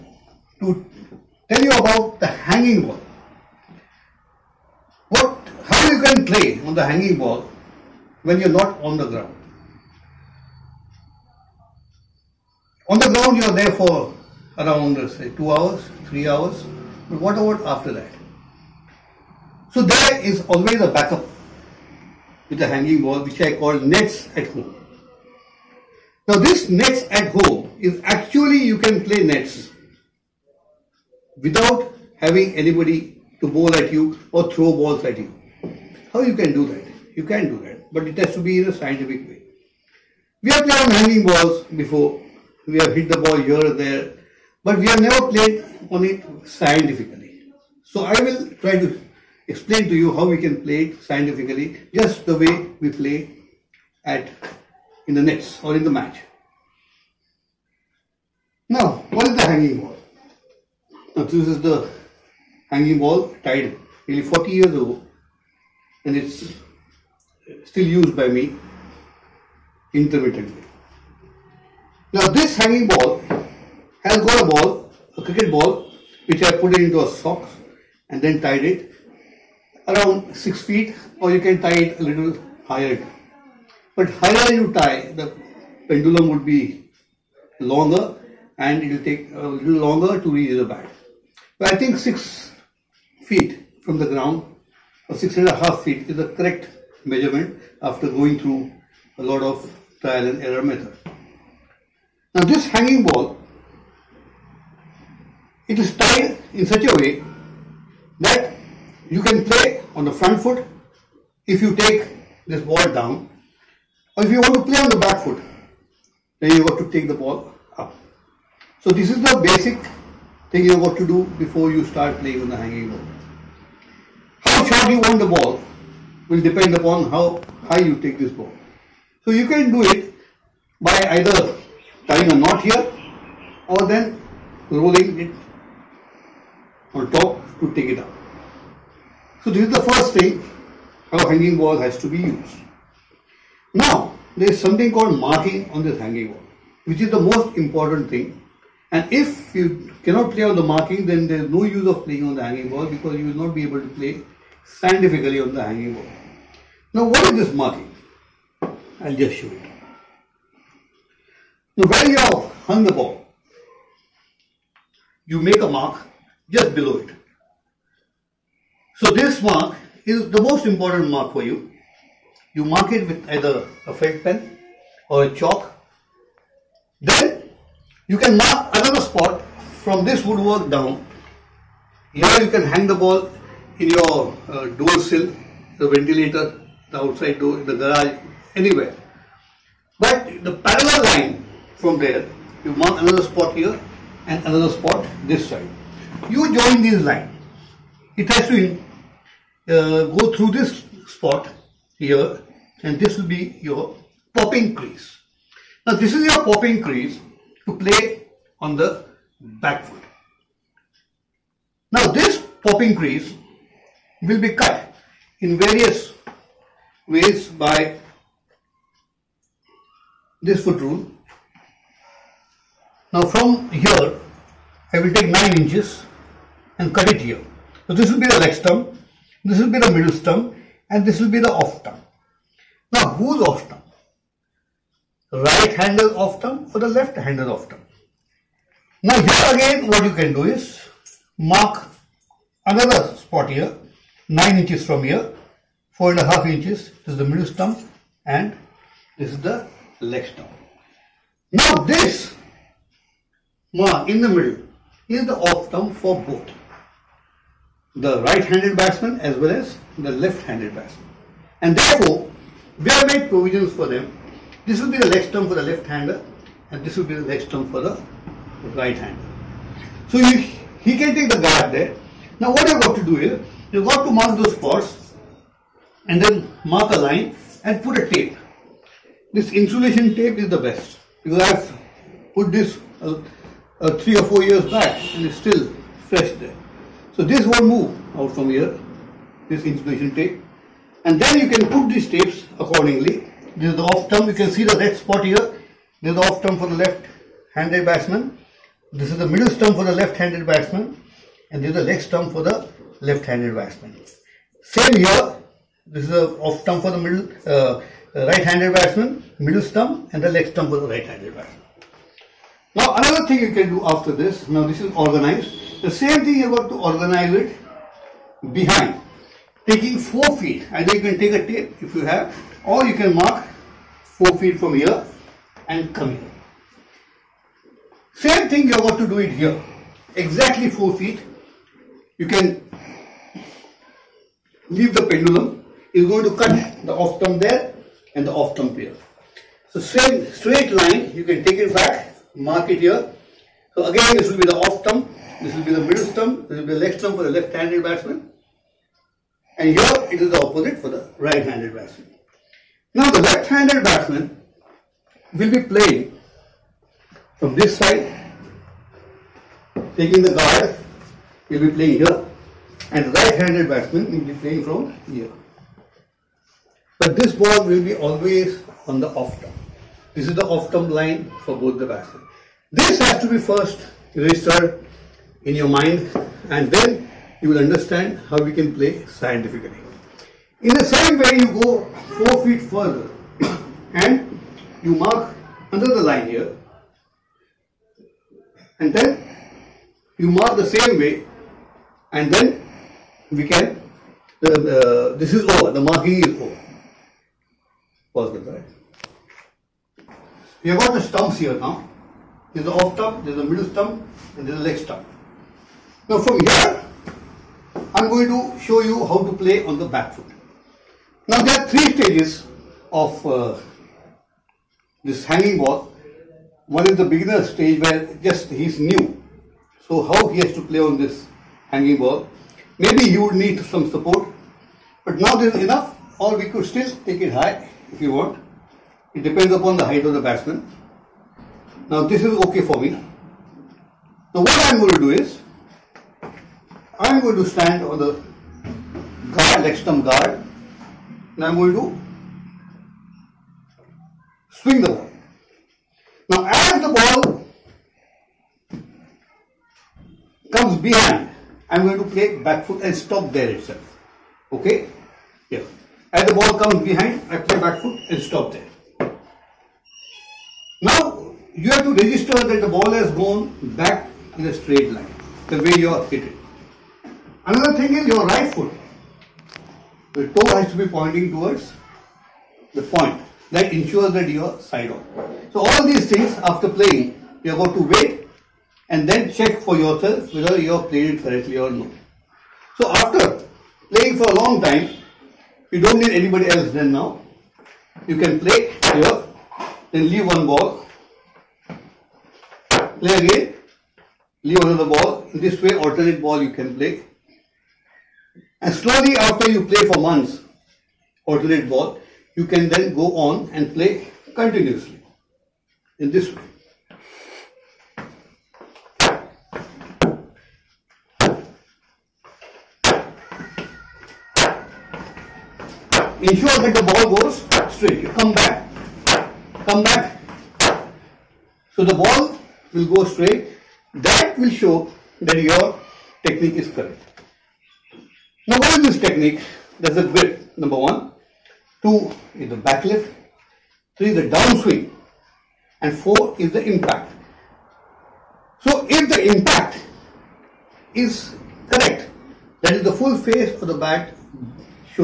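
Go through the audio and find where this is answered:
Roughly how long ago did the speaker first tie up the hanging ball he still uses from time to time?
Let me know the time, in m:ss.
1:04.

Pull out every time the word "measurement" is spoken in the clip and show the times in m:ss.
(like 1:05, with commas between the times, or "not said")
1:37.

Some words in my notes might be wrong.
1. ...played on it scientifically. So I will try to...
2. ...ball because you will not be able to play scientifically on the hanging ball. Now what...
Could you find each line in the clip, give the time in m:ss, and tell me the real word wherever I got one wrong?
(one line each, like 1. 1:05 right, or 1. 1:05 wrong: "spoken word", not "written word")
1. 0:45 right
2. 2:32 right.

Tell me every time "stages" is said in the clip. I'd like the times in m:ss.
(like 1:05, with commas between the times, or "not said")
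6:51, 6:57.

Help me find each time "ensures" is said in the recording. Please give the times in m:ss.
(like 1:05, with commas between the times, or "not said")
7:53, 8:36.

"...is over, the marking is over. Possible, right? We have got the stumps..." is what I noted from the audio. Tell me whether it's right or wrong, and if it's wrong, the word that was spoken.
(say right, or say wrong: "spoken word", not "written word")
right.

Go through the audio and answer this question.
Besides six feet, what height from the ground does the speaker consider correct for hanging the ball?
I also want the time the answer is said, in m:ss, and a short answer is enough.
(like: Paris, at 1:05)
6 and a half feet, at 1:35.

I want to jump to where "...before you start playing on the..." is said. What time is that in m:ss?
2:01.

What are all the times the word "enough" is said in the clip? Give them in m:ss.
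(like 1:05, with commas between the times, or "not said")
7:05.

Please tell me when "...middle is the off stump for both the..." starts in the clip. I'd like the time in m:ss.
4:14.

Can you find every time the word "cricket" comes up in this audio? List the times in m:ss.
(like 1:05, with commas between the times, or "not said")
1:15.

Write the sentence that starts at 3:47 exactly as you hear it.
So this will be the leg stump, this will be the middle stump and this will be the off stump.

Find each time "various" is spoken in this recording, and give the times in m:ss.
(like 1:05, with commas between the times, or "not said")
3:35.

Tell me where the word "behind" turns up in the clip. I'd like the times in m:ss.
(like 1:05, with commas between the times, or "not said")
5:18, 7:30, 7:36.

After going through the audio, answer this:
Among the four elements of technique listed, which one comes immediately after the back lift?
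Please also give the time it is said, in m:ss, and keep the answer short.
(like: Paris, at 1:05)
Downswing, at 8:54.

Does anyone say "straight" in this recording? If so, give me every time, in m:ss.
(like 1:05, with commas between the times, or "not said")
5:40, 7:44, 8:37, 8:43.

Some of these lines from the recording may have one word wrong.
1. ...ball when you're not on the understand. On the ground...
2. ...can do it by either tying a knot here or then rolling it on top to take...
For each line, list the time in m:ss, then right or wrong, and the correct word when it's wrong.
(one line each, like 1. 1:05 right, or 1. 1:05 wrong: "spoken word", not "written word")
1. 0:07 wrong: "ground", not "understand"
2. 2:09 right.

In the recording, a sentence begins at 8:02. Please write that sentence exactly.
So after playing for a long time, you don't need anybody else then now.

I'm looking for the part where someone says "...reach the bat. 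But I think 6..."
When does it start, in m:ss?
1:30.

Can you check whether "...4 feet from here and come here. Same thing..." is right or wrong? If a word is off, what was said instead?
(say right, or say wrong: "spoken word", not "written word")
right.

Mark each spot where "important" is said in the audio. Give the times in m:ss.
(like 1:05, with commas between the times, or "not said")
2:27, 2:50.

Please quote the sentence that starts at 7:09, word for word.
It depends upon the height of the batsman.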